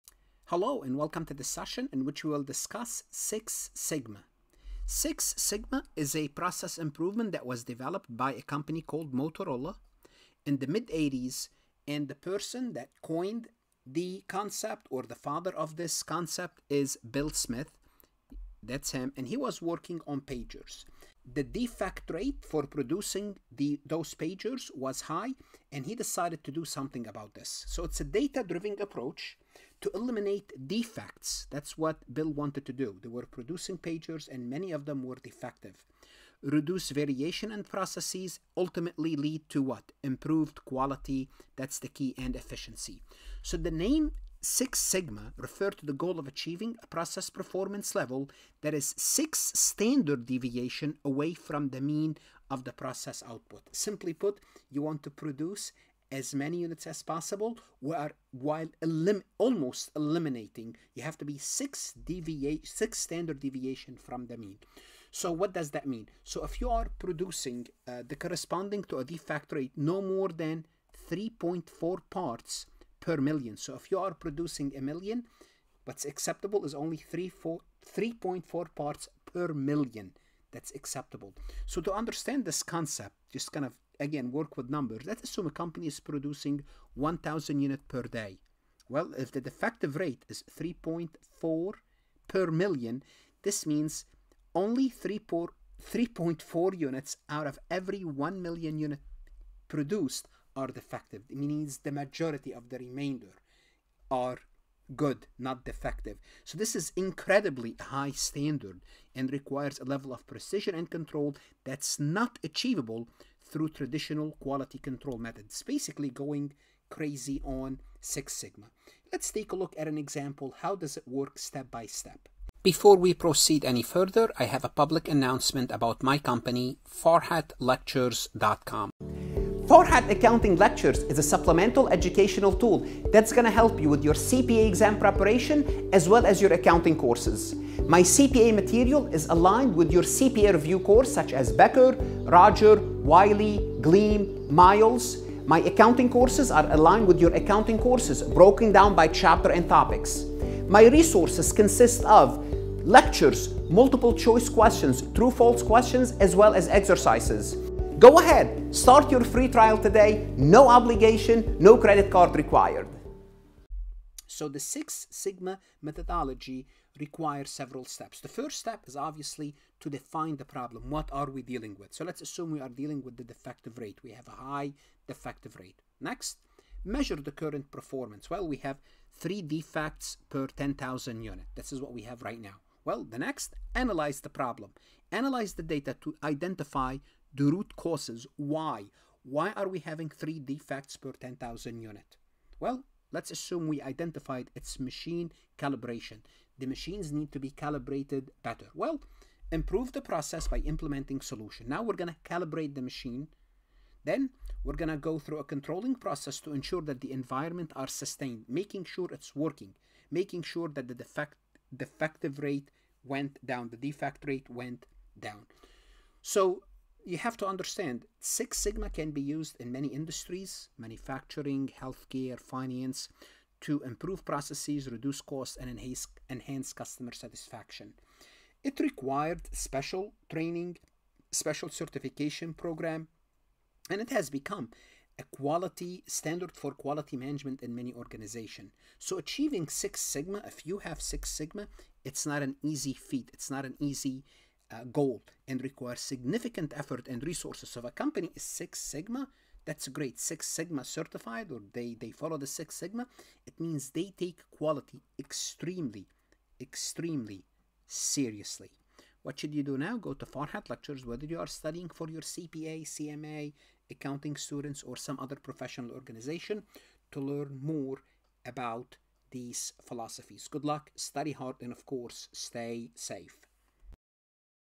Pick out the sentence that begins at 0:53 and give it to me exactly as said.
Simply put, you want to produce as many units as possible while, while elim almost eliminating.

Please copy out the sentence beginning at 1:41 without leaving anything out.
It means the majority of the remainder are good, not defective.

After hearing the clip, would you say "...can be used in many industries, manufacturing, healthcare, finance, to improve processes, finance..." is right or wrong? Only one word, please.
wrong.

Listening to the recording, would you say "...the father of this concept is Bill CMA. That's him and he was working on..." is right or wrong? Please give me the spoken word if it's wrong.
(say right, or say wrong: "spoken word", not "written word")
wrong: "Smith", not "CMA".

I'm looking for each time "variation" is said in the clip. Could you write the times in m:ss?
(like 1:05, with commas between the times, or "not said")
0:36.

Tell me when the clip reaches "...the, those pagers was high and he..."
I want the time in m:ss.
0:23.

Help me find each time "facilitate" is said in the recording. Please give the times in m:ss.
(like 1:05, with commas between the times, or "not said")
not said.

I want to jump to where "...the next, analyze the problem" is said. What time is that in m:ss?
3:03.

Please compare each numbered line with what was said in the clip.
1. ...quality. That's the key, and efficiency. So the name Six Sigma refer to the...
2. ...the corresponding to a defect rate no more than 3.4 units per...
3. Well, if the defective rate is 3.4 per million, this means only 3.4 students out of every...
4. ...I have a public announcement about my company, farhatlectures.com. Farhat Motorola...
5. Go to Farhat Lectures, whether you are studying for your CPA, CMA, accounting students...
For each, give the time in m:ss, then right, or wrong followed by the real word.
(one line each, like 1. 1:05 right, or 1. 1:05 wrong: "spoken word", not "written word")
1. 0:40 right
2. 1:08 wrong: "parts", not "units"
3. 1:28 wrong: "units", not "students"
4. 2:04 wrong: "Accounting", not "Motorola"
5. 4:19 right.